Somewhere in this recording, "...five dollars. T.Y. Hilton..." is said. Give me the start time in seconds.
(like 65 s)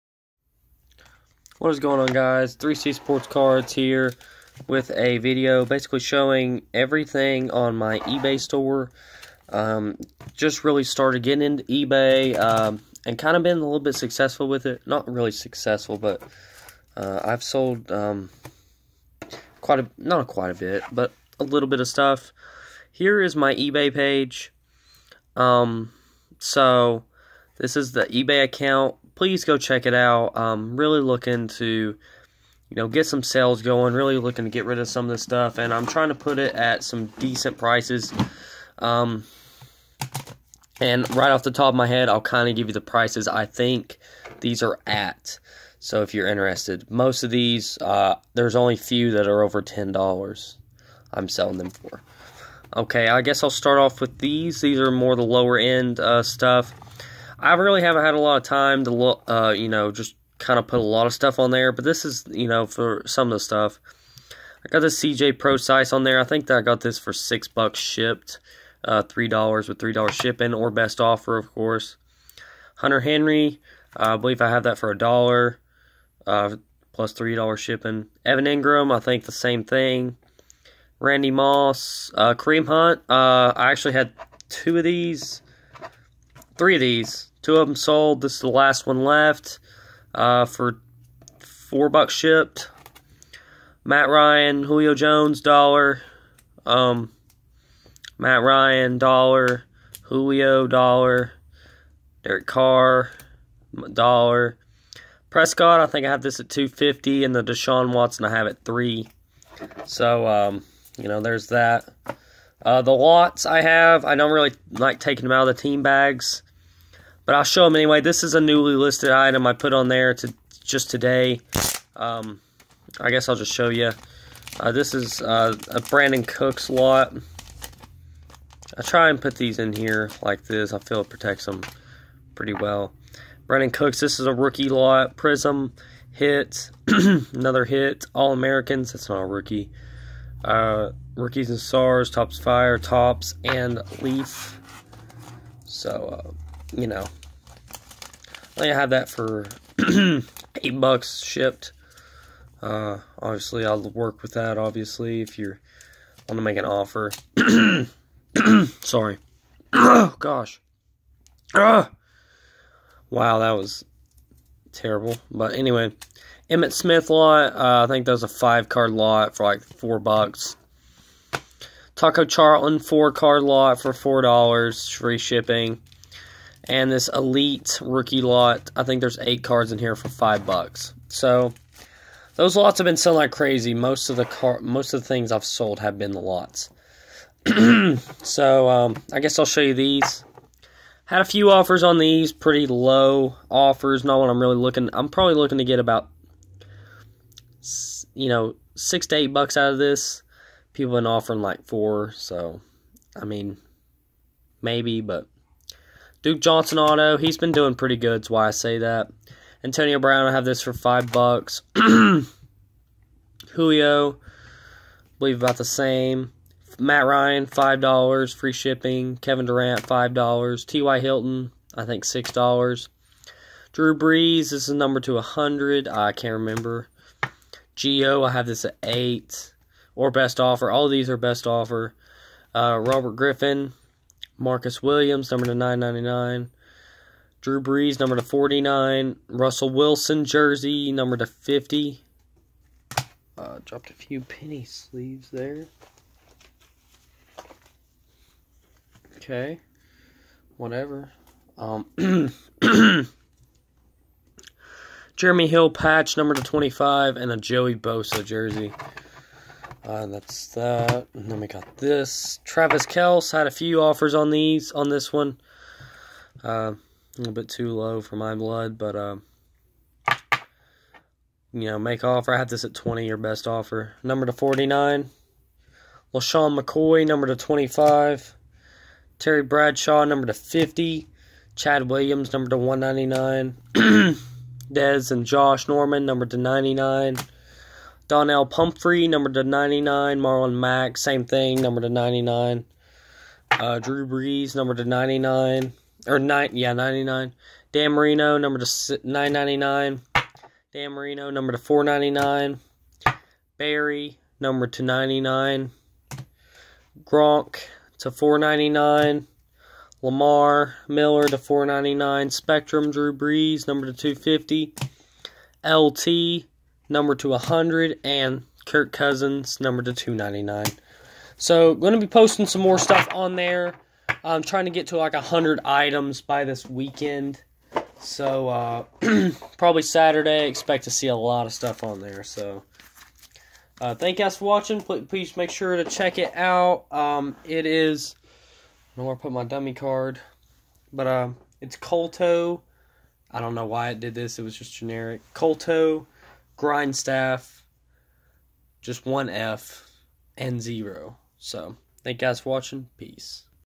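219 s.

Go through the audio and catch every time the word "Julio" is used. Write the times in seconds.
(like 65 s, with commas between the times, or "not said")
94 s, 100 s, 213 s.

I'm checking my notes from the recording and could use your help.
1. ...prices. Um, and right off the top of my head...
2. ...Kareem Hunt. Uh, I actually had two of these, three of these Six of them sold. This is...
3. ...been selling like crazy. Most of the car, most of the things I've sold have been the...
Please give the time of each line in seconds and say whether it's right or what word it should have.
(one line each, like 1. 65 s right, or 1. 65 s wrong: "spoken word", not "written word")
1. 37 s right
2. 82 s wrong: "Two", not "Six"
3. 182 s right.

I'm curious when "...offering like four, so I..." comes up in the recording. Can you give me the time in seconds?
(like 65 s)
201 s.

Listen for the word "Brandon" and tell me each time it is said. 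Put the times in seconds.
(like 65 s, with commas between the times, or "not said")
125 s, 133 s.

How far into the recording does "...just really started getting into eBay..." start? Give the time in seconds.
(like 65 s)
10 s.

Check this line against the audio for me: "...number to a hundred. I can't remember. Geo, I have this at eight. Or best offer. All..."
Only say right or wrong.
right.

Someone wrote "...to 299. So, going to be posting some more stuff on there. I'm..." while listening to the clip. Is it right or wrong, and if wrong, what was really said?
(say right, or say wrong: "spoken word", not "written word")
right.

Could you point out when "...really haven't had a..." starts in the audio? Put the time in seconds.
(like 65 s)
57 s.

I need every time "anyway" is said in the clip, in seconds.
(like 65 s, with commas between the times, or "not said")
117 s, 165 s.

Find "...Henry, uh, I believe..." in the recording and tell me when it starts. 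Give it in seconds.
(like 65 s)
72 s.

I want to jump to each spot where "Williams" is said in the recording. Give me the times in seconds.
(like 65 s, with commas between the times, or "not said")
234 s, 281 s.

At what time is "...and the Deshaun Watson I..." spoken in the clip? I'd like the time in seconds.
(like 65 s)
107 s.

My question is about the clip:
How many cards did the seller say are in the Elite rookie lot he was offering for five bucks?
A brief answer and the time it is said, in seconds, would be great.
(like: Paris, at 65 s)
8, at 179 s.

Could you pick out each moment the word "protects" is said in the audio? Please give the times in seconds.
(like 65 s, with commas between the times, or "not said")
131 s.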